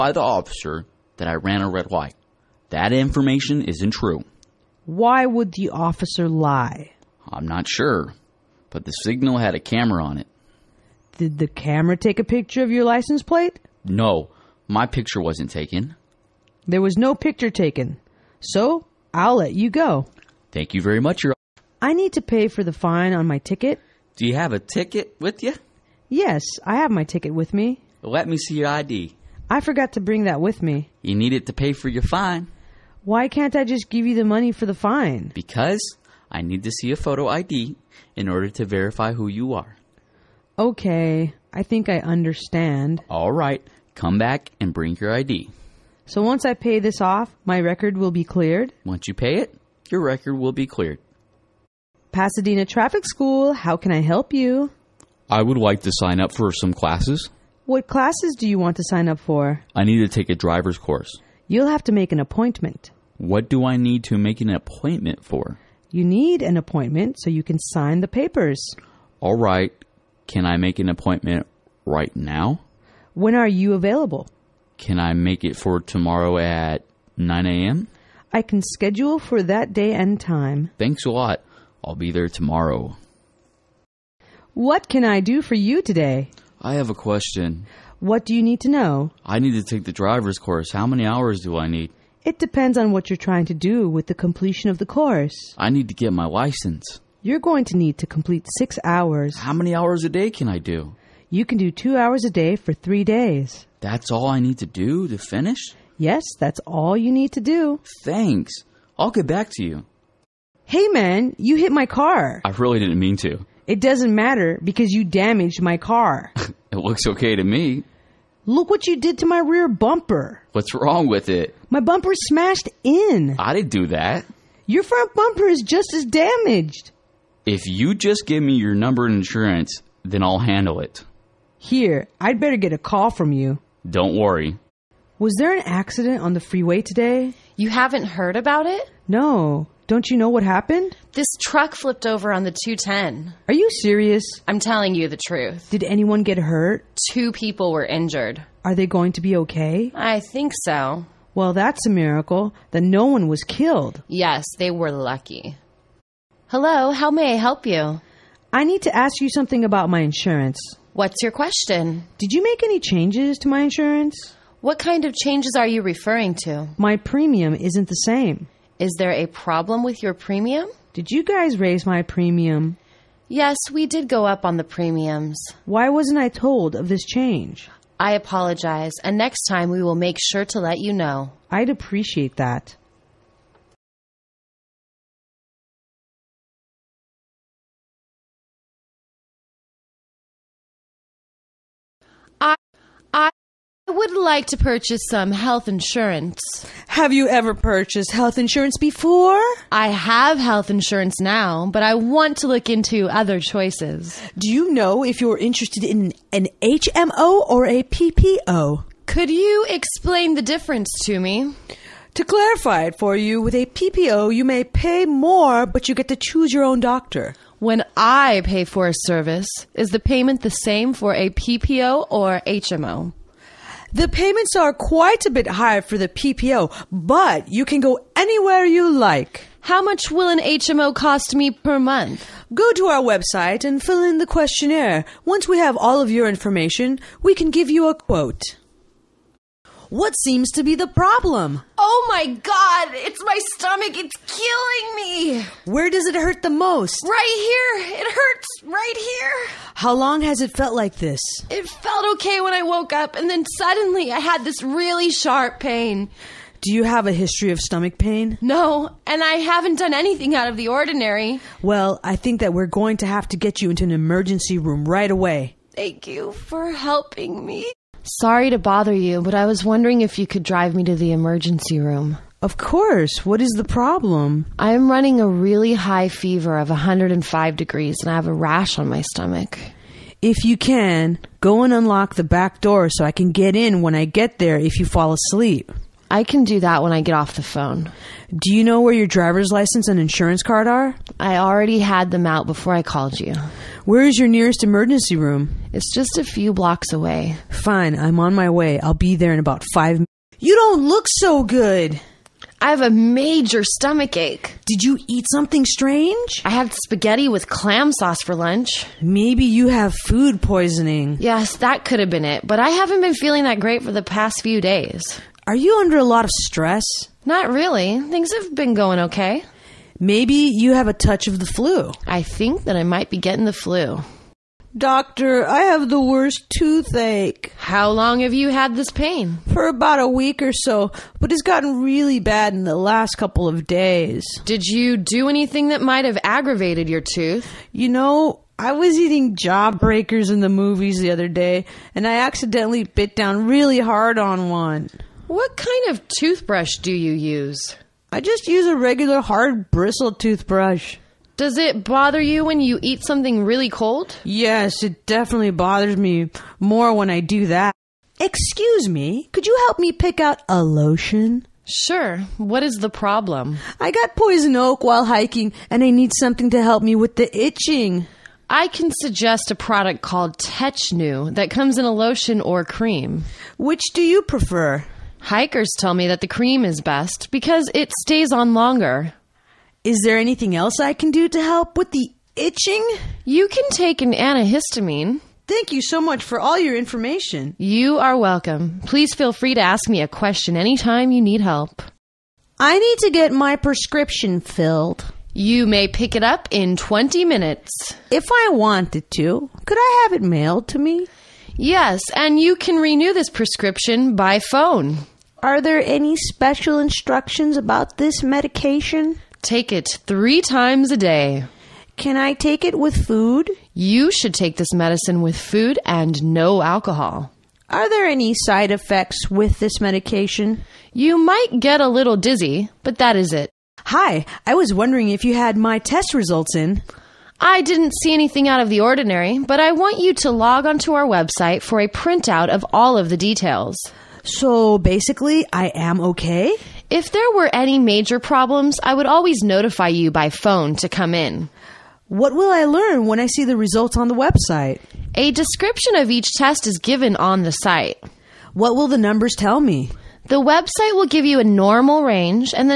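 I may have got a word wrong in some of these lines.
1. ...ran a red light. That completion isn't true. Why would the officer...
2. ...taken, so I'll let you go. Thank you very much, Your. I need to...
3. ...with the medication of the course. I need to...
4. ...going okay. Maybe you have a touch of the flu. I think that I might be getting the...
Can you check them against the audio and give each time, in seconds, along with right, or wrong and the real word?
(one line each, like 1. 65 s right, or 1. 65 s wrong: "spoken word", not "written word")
1. 1 s wrong: "information", not "completion"
2. 17 s right
3. 93 s wrong: "completion", not "medication"
4. 318 s right.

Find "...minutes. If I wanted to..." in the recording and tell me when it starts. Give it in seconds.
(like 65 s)
397 s.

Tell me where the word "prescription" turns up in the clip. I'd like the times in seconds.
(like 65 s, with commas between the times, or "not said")
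393 s, 403 s.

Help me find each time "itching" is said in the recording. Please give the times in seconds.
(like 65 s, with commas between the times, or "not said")
367 s, 382 s.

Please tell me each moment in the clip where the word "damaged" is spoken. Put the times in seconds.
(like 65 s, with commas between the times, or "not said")
115 s, 126 s.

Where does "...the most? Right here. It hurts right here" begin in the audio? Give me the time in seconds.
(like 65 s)
246 s.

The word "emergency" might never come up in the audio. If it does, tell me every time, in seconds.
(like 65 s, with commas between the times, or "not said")
263 s, 271 s, 294 s.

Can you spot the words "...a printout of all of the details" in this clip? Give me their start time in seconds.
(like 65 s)
431 s.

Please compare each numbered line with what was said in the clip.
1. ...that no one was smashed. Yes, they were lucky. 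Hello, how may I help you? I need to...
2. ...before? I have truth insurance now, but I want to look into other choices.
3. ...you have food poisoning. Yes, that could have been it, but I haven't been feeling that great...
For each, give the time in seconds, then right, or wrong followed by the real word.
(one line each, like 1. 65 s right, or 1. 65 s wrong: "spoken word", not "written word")
1. 152 s wrong: "killed", not "smashed"
2. 198 s wrong: "health", not "truth"
3. 309 s right.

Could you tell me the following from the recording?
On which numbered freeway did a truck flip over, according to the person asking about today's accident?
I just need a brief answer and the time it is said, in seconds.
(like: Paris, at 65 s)
The 210, at 142 s.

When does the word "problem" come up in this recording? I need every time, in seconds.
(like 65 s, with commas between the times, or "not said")
169 s, 240 s, 273 s, 362 s, 438 s.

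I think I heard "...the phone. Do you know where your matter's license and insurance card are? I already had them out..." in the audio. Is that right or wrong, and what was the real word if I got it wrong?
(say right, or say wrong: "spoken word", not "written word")
wrong: "driver", not "matter".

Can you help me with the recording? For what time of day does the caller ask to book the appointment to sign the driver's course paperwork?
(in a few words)
9 a.m.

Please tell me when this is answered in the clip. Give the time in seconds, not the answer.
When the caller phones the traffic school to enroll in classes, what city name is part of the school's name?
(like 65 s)
52 s.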